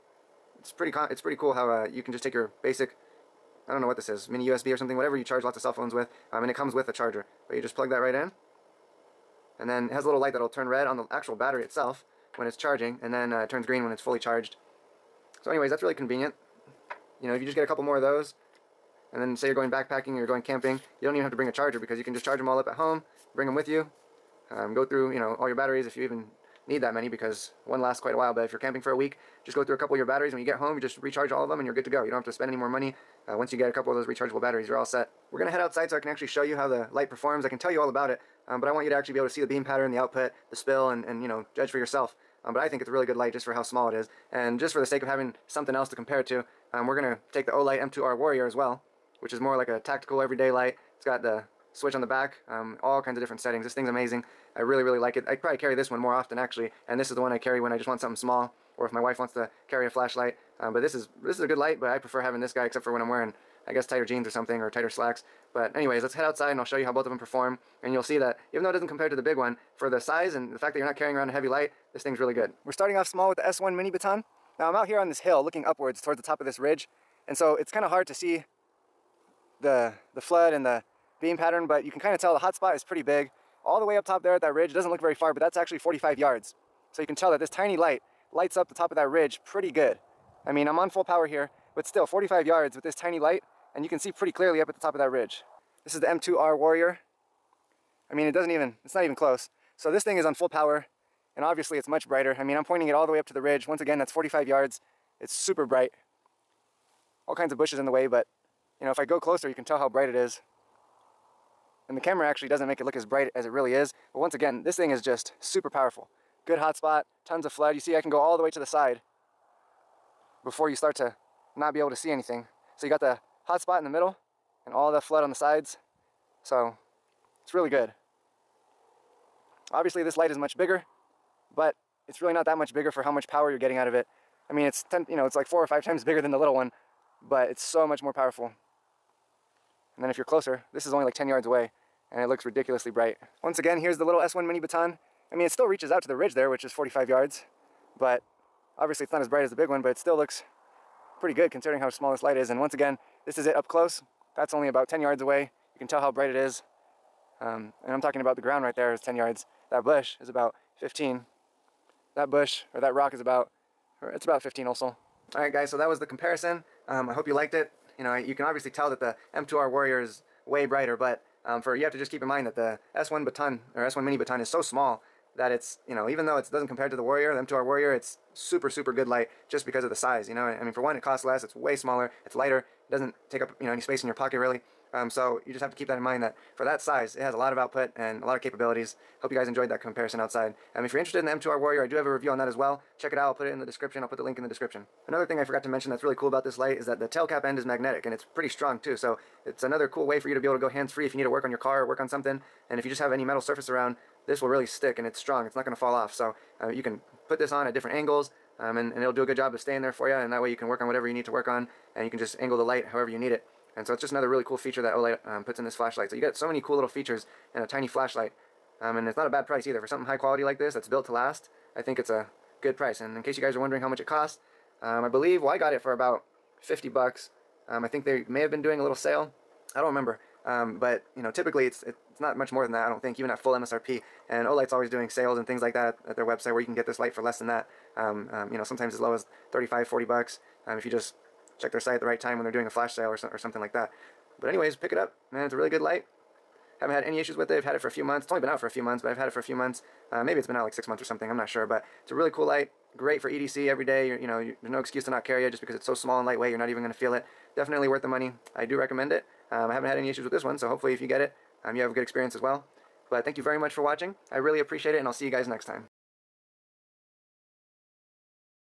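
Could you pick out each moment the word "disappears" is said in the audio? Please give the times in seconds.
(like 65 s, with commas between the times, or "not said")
not said.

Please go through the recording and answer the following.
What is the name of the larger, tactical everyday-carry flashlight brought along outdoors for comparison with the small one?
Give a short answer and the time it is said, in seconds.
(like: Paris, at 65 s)
Olight M2R Warrior, at 47 s.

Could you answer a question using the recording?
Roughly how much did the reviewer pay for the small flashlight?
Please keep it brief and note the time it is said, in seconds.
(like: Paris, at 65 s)
$50, at 226 s.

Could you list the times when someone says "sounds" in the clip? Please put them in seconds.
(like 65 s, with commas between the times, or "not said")
not said.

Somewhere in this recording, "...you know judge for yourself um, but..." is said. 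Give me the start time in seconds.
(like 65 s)
41 s.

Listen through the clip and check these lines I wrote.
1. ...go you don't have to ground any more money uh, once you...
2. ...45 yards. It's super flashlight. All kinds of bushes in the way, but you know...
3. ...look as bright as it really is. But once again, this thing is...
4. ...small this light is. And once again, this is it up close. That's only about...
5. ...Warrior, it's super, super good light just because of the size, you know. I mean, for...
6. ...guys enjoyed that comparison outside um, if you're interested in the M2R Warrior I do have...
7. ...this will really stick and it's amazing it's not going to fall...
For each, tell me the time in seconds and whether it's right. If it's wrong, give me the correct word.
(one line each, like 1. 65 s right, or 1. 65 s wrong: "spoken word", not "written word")
1. 31 s wrong: "spend", not "ground"
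2. 104 s wrong: "bright", not "flashlight"
3. 112 s right
4. 151 s right
5. 177 s right
6. 189 s right
7. 204 s wrong: "strong", not "amazing".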